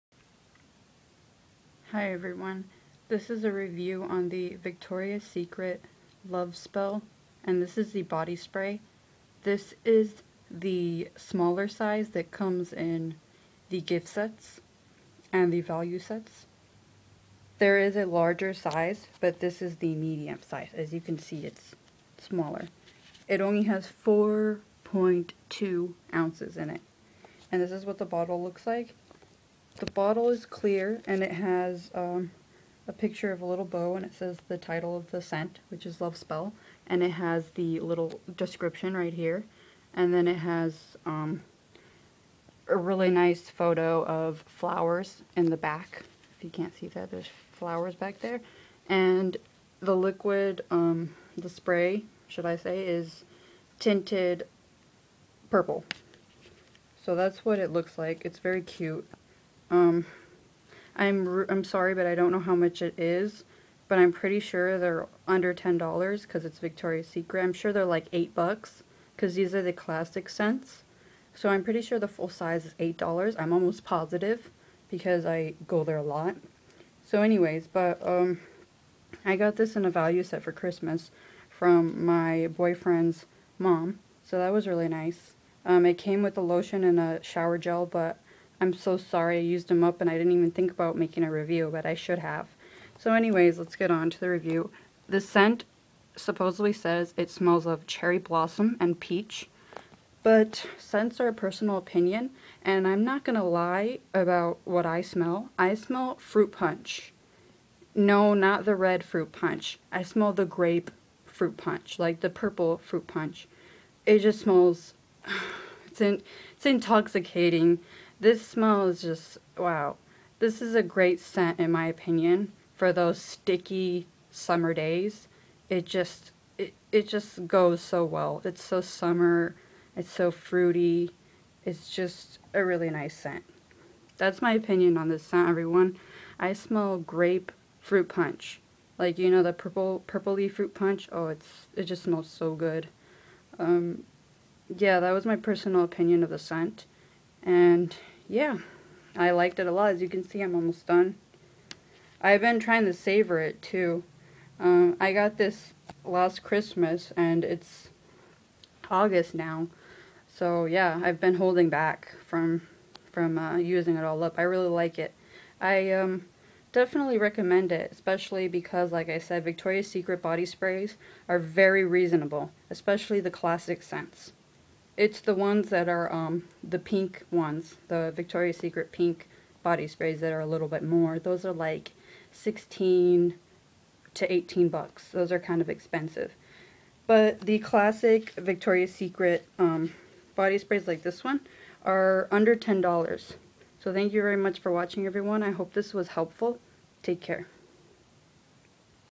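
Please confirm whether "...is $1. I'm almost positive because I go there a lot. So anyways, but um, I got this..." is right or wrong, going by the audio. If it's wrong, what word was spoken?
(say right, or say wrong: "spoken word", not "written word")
wrong: "8", not "1".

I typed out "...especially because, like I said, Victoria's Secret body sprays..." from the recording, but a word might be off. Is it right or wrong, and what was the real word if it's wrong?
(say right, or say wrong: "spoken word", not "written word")
right.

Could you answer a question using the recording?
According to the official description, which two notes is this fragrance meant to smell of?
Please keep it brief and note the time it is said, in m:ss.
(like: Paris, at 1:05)
cherry blossom and peach, at 1:37.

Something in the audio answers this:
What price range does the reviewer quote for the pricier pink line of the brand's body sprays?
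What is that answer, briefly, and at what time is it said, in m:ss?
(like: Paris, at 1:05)
$16 to $18, at 3:02.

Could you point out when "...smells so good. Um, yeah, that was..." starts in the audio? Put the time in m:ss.
2:22.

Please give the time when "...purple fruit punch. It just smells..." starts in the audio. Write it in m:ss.
1:52.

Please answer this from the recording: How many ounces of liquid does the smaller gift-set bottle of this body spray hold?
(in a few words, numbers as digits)
4.2 ounces.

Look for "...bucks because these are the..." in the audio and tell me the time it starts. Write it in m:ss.
1:08.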